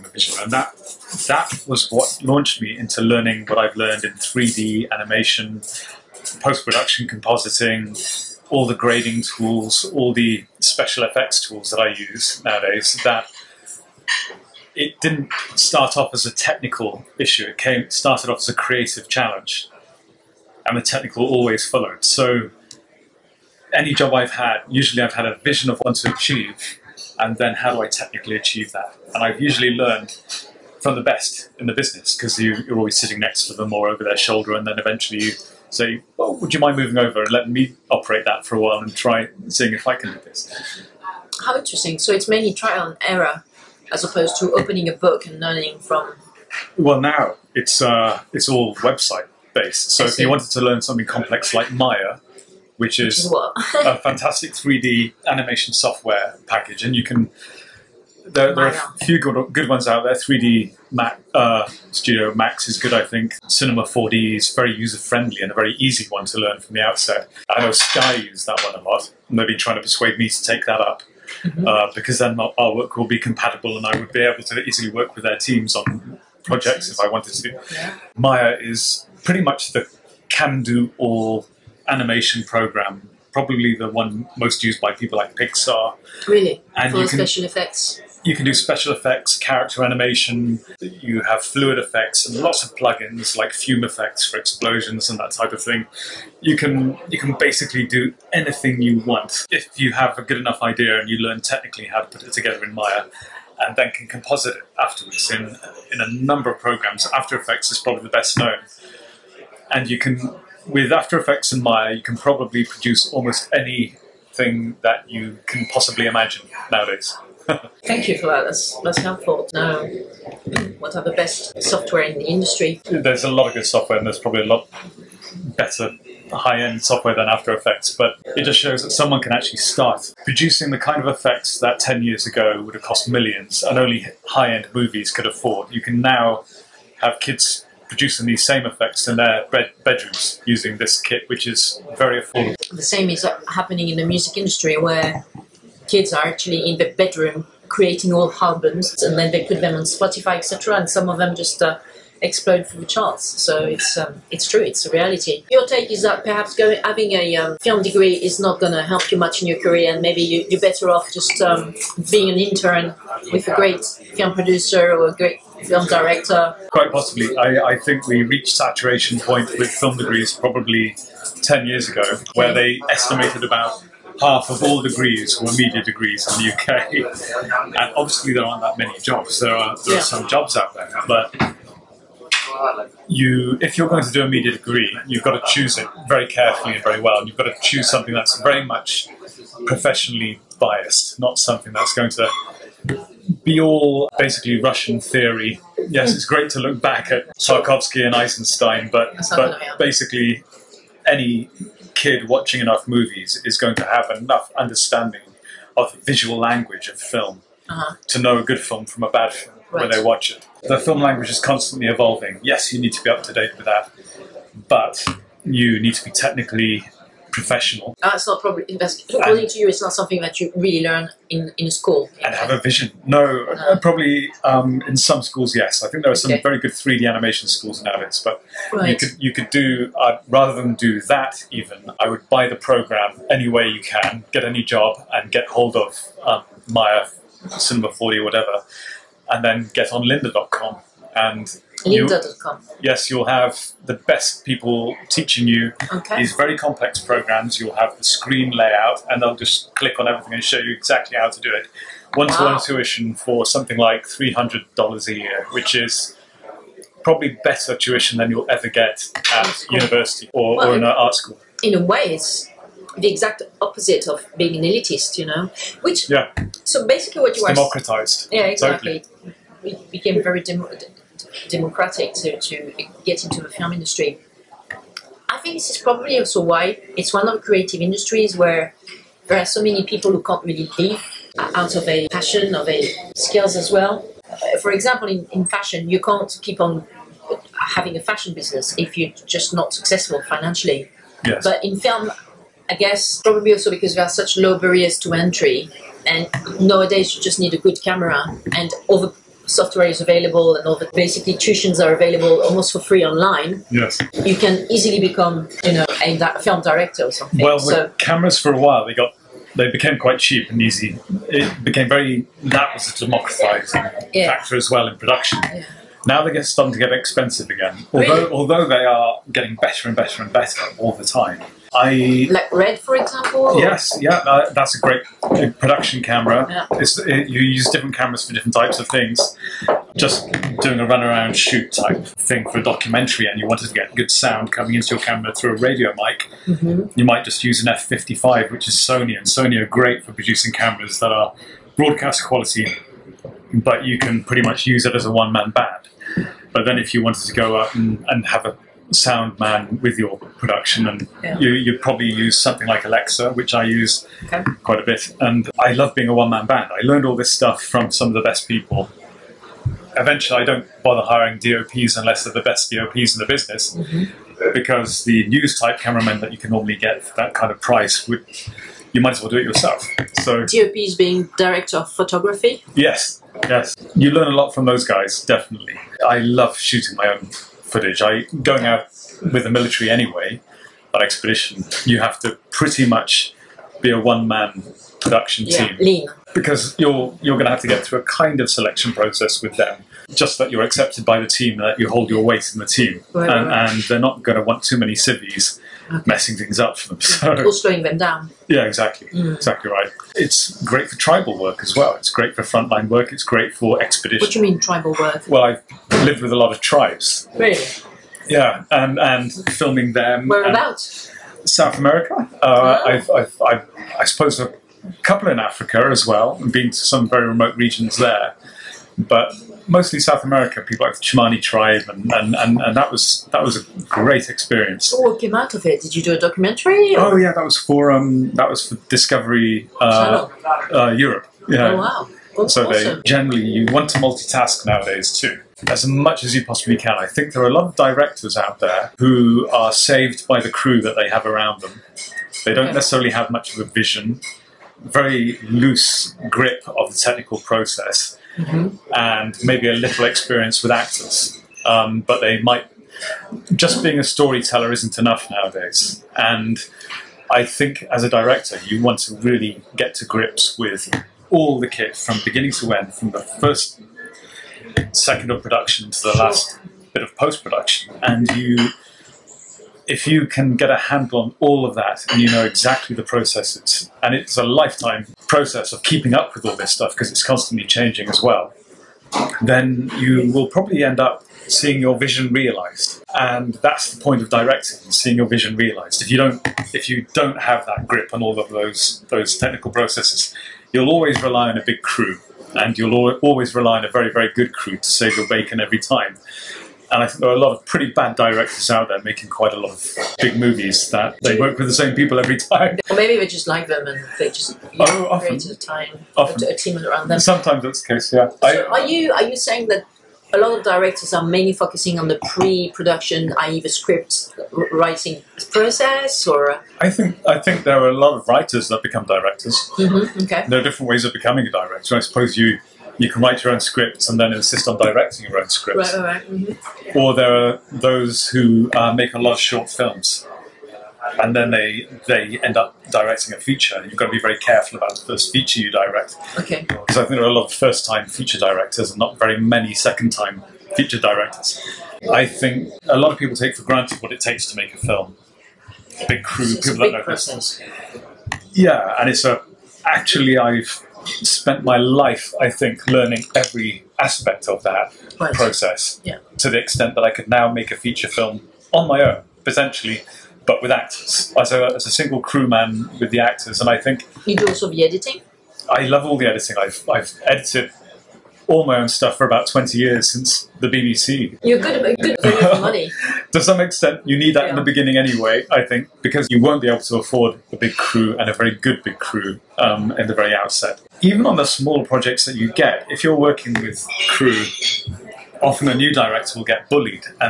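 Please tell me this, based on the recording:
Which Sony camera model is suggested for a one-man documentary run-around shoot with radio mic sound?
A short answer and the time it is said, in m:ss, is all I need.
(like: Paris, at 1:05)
F55, at 5:37.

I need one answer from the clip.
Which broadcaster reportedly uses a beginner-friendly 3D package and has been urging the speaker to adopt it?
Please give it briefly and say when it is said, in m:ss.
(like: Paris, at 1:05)
Sky, at 1:07.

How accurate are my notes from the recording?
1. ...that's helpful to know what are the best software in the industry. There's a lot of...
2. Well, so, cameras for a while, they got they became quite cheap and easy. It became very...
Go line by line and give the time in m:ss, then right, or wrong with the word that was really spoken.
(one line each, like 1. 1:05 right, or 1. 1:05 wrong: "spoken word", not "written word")
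1. 1:58 right
2. 5:07 right.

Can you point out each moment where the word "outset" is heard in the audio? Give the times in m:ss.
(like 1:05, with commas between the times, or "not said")
1:06, 9:40.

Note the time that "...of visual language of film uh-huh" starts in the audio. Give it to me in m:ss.
3:25.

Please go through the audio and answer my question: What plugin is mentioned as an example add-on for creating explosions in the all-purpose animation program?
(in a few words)
fume effects.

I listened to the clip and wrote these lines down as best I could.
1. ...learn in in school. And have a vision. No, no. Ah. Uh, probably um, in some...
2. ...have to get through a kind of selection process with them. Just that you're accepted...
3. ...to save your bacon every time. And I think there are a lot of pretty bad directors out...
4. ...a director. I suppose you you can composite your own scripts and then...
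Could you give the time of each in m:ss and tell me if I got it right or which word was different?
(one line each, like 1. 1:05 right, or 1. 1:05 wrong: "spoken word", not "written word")
1. 3:40 right
2. 6:27 right
3. 8:14 right
4. 8:41 wrong: "write", not "composite".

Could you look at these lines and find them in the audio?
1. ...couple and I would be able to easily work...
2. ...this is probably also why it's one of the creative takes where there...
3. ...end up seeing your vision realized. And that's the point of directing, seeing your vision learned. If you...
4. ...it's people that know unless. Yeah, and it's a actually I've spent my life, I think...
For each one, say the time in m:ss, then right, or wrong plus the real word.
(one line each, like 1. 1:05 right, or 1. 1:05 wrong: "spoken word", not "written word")
1. 1:13 wrong: "compatible", not "couple"
2. 4:35 wrong: "industries", not "takes"
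3. 8:00 wrong: "realized", not "learned"
4. 9:06 wrong: "process", not "unless".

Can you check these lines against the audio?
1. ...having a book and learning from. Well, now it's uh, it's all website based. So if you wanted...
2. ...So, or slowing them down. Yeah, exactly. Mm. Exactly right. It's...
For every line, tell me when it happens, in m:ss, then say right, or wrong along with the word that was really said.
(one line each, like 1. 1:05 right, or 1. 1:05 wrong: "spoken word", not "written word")
1. 0:44 wrong: "opening", not "having"
2. 6:37 right.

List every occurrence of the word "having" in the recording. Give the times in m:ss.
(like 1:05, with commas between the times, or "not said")
2:36, 4:47.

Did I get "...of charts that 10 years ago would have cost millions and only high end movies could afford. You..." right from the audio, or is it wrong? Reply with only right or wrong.
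wrong.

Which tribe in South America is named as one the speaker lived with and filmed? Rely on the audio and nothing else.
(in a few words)
Chimani.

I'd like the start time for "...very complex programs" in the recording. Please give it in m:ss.
4:06.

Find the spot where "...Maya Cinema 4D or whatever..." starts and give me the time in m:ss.
3:56.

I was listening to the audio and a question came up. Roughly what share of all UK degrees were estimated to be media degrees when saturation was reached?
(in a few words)
half.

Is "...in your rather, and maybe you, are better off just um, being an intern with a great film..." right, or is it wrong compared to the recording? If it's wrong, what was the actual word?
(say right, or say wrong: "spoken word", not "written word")
wrong: "career", not "rather".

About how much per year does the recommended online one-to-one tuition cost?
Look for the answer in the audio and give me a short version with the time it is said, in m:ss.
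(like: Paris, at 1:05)
$300, at 4:14.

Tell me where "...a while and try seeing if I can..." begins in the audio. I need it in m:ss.
0:38.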